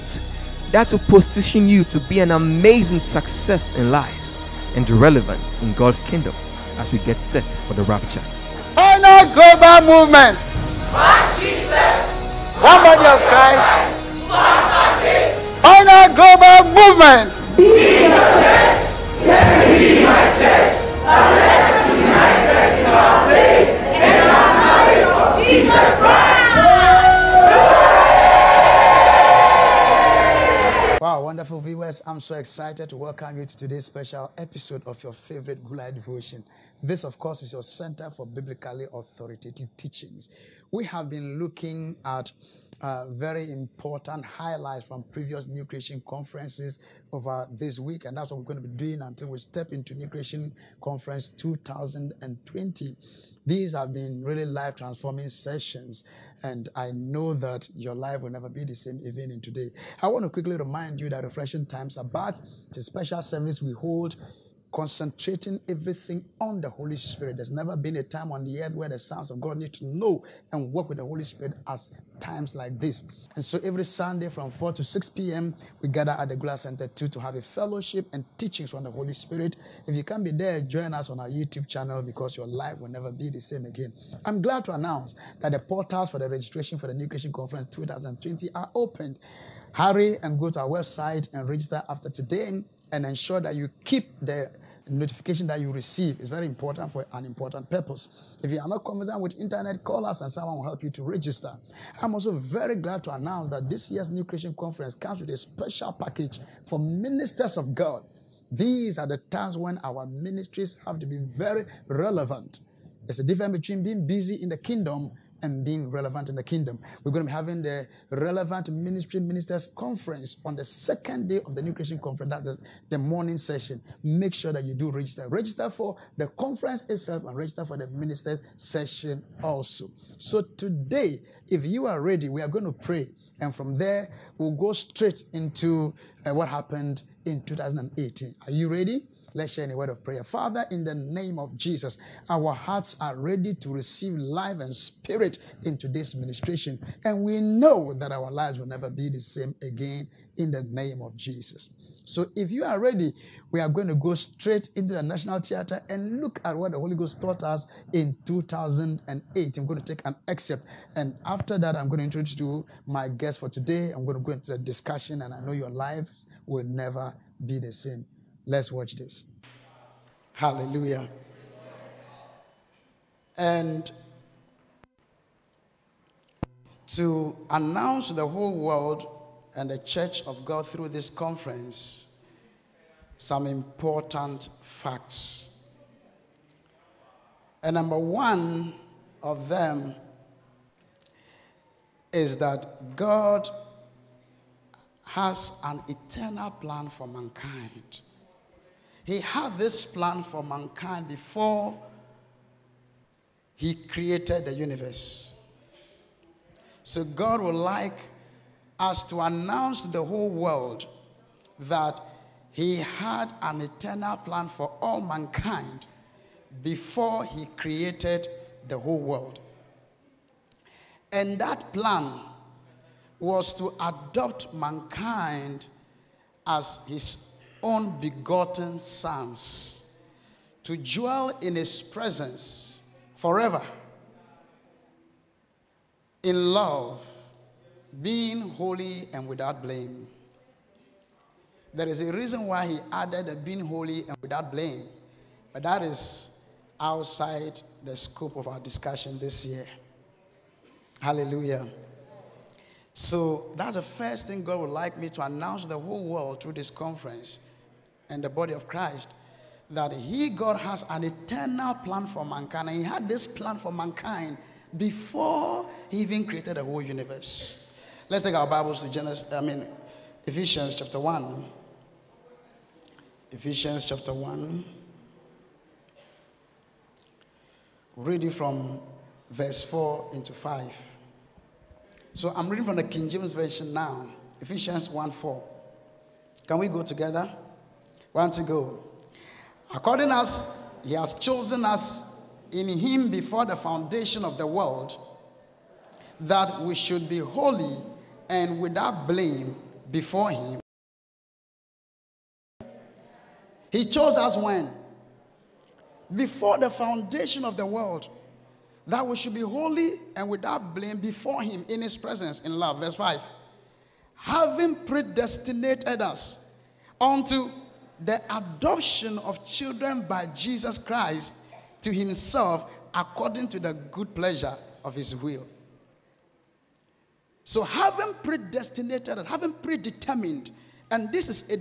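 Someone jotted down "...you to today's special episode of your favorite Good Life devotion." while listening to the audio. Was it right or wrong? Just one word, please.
right.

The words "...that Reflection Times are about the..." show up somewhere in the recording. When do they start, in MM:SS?
01:01.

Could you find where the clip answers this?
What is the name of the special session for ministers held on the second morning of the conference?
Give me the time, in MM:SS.
01:58.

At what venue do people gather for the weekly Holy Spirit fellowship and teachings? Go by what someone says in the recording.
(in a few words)
Glass Center 2.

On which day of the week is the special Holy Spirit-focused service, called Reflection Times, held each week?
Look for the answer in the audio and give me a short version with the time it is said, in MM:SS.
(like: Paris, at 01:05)
Sunday, at 01:13.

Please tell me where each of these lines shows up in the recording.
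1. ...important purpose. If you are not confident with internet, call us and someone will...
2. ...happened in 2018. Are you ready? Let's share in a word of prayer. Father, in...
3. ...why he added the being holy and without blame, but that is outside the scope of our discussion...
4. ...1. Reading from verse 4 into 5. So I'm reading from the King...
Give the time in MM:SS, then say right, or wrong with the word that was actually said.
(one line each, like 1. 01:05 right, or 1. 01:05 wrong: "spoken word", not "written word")
1. 01:37 right
2. 02:16 right
3. 04:02 right
4. 04:34 right.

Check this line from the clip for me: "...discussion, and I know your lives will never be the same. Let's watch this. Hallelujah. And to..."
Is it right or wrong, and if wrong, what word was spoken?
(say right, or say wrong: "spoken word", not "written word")
right.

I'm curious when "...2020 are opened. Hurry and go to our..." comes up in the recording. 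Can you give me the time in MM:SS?
01:27.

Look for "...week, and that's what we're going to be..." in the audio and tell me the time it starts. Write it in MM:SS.
00:47.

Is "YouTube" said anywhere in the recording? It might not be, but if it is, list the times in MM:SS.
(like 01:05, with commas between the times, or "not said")
01:21.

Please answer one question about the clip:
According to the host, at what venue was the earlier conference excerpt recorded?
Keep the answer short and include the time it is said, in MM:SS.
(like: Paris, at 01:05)
National Theater, at 02:35.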